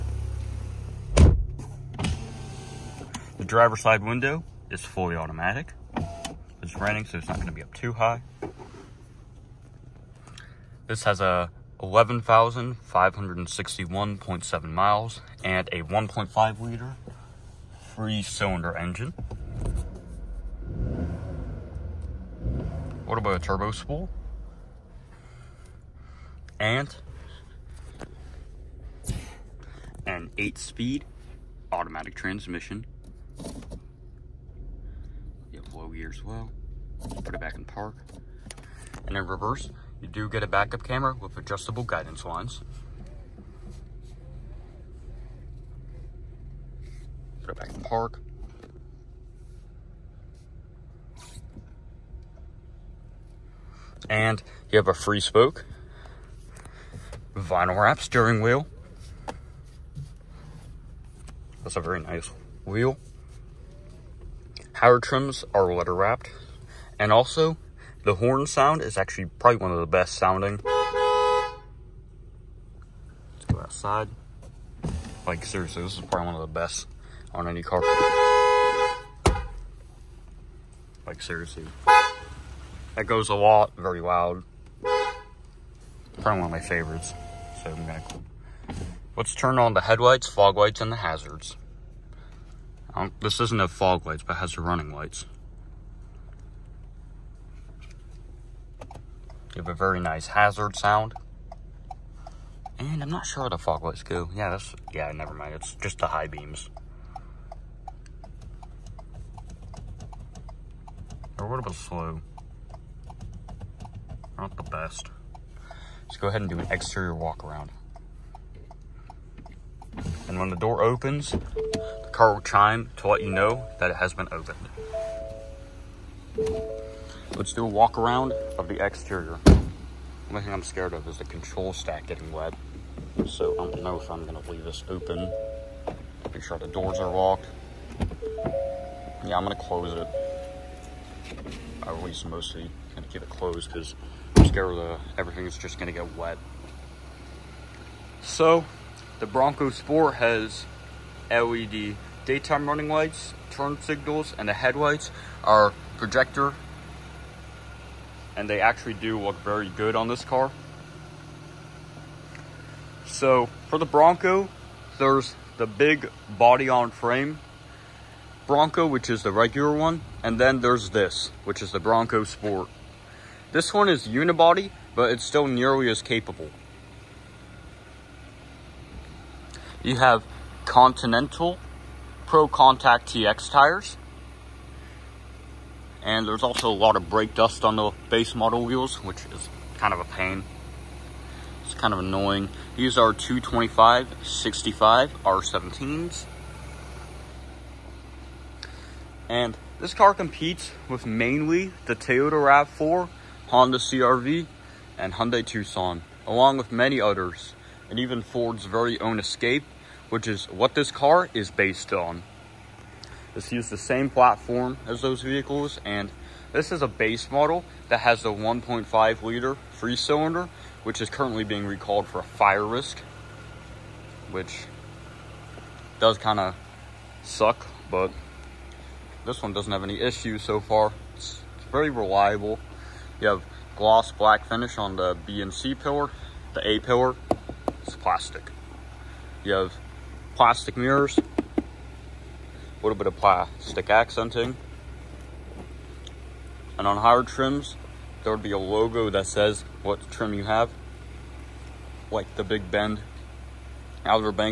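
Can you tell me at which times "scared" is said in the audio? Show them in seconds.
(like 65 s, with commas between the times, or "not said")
130 s, 144 s.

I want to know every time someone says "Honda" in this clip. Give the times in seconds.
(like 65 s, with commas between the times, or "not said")
203 s.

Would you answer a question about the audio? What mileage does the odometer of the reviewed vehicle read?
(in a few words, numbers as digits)
11,561.7.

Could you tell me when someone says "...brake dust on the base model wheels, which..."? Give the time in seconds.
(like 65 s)
187 s.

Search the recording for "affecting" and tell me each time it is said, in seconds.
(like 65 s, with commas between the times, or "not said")
not said.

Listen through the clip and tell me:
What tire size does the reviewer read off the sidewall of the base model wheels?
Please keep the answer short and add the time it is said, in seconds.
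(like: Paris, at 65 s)
225/65 R17, at 193 s.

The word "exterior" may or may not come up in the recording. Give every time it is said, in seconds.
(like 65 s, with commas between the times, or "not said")
116 s, 128 s.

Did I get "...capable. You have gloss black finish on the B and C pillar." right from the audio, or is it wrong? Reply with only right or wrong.
wrong.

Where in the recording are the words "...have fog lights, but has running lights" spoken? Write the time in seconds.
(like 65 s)
93 s.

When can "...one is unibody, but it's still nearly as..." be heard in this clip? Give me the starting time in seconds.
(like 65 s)
173 s.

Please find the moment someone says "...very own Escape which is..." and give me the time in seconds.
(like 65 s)
208 s.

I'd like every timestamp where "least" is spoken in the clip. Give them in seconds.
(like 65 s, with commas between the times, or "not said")
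142 s.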